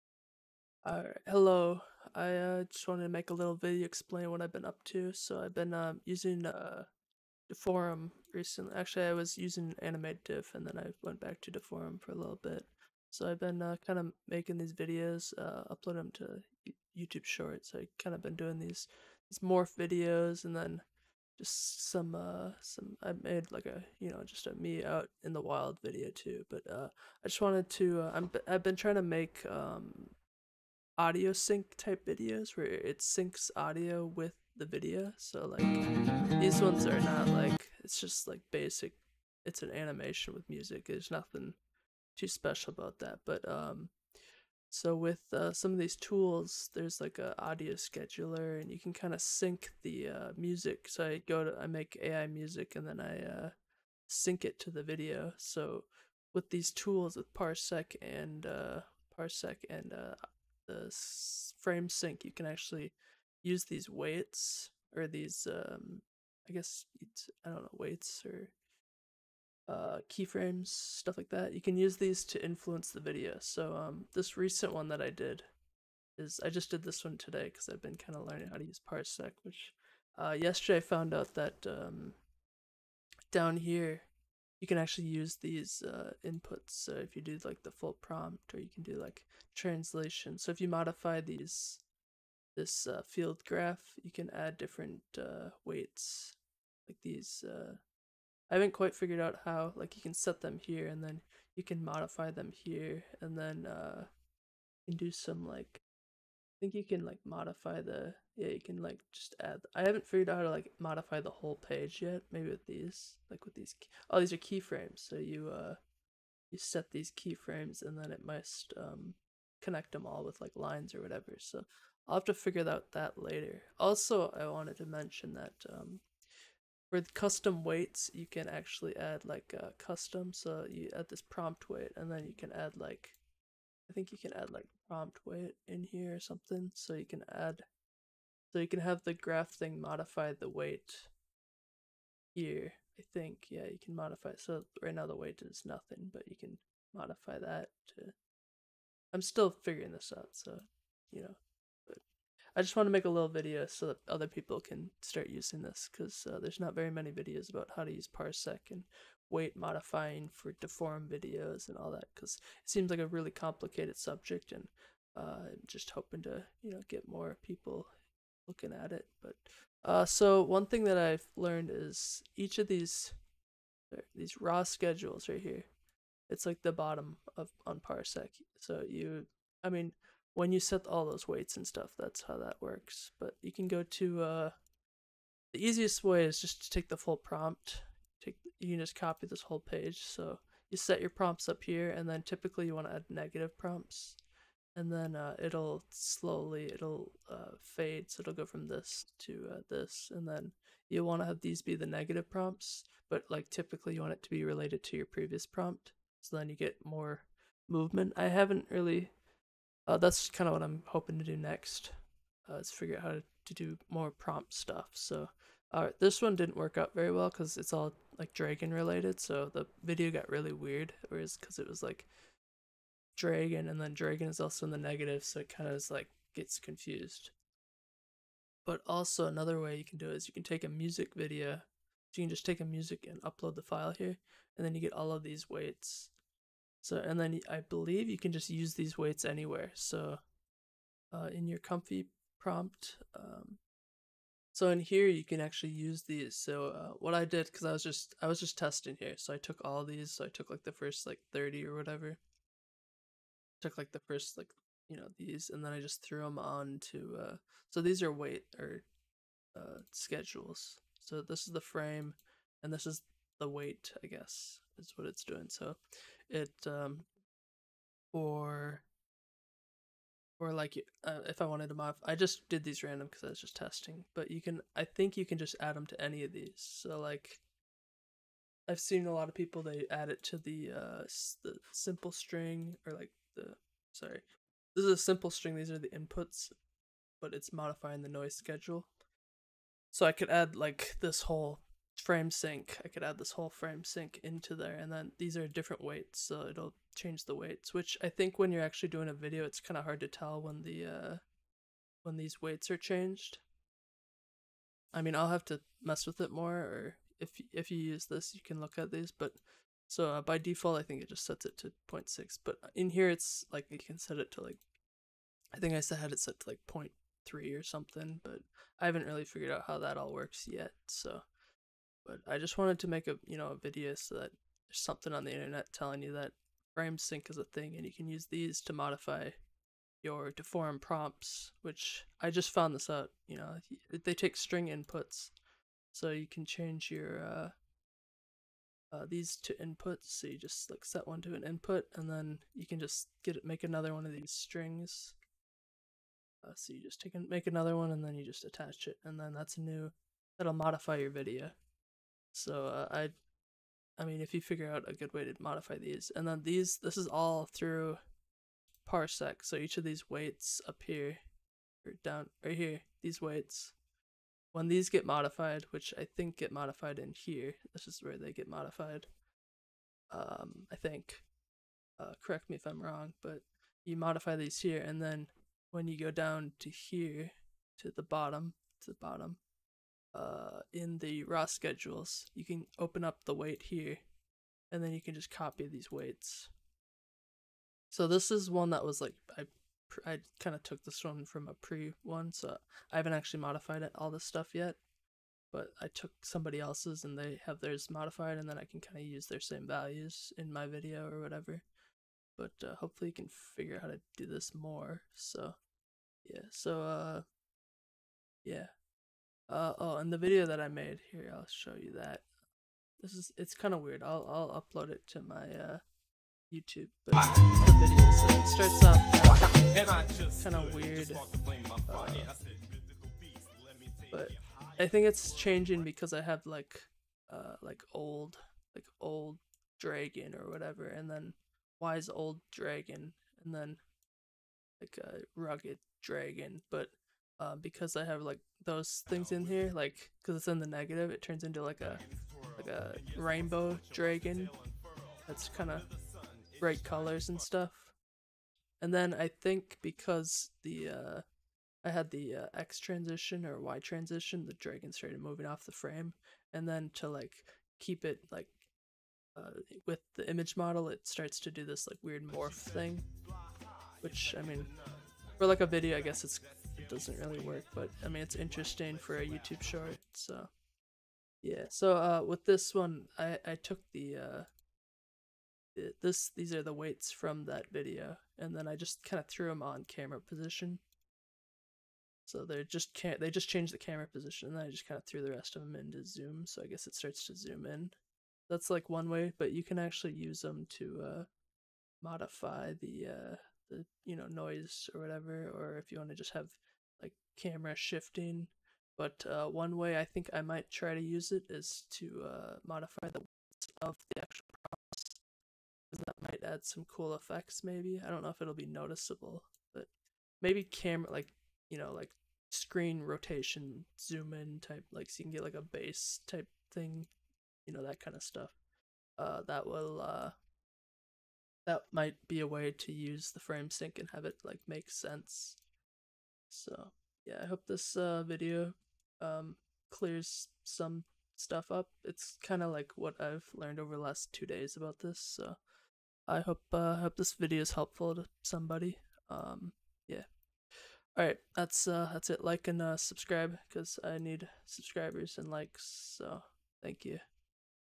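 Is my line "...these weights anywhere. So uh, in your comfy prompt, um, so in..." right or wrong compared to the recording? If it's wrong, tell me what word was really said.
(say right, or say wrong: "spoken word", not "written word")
right.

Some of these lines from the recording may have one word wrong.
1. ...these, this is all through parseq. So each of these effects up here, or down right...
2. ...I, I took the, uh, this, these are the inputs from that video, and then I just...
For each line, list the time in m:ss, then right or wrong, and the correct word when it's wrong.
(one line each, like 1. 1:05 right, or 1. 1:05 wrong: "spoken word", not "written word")
1. 5:56 wrong: "weights", not "effects"
2. 7:53 wrong: "weights", not "inputs".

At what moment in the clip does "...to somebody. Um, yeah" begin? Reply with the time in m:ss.
8:58.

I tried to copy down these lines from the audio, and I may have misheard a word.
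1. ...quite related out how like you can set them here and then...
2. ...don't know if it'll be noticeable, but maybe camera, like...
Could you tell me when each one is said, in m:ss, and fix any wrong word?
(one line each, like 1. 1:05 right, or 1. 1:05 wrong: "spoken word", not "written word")
1. 1:38 wrong: "figured", not "related"
2. 8:28 right.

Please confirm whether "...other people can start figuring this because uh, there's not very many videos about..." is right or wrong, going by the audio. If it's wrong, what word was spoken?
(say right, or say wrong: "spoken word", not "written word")
wrong: "using", not "figuring".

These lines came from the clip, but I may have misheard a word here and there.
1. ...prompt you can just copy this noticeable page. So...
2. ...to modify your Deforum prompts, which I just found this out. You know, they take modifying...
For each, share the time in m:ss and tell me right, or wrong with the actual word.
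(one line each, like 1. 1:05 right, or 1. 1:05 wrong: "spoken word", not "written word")
1. 3:07 wrong: "whole", not "noticeable"
2. 5:28 wrong: "string", not "modifying".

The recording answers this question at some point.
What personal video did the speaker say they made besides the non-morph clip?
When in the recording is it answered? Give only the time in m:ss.
0:24.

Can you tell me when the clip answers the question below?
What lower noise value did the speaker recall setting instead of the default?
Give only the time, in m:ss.
5:16.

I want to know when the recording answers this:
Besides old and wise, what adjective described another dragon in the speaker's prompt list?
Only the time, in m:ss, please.
7:15.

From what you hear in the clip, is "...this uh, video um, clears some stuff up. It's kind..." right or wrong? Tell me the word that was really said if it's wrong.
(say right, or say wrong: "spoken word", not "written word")
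right.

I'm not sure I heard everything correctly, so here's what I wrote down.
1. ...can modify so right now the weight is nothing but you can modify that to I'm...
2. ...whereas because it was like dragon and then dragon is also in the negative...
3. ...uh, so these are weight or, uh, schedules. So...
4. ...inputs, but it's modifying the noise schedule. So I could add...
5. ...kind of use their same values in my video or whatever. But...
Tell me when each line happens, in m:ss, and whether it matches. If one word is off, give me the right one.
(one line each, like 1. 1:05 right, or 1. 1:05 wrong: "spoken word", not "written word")
1. 2:23 right
2. 3:41 right
3. 4:17 right
4. 4:45 right
5. 6:38 right.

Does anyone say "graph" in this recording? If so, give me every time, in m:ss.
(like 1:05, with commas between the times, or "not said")
1:33, 2:19.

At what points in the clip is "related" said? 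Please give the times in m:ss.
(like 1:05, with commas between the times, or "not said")
3:24, 3:38.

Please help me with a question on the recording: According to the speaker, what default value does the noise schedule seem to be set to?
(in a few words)
0.6.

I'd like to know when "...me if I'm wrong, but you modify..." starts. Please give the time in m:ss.
6:12.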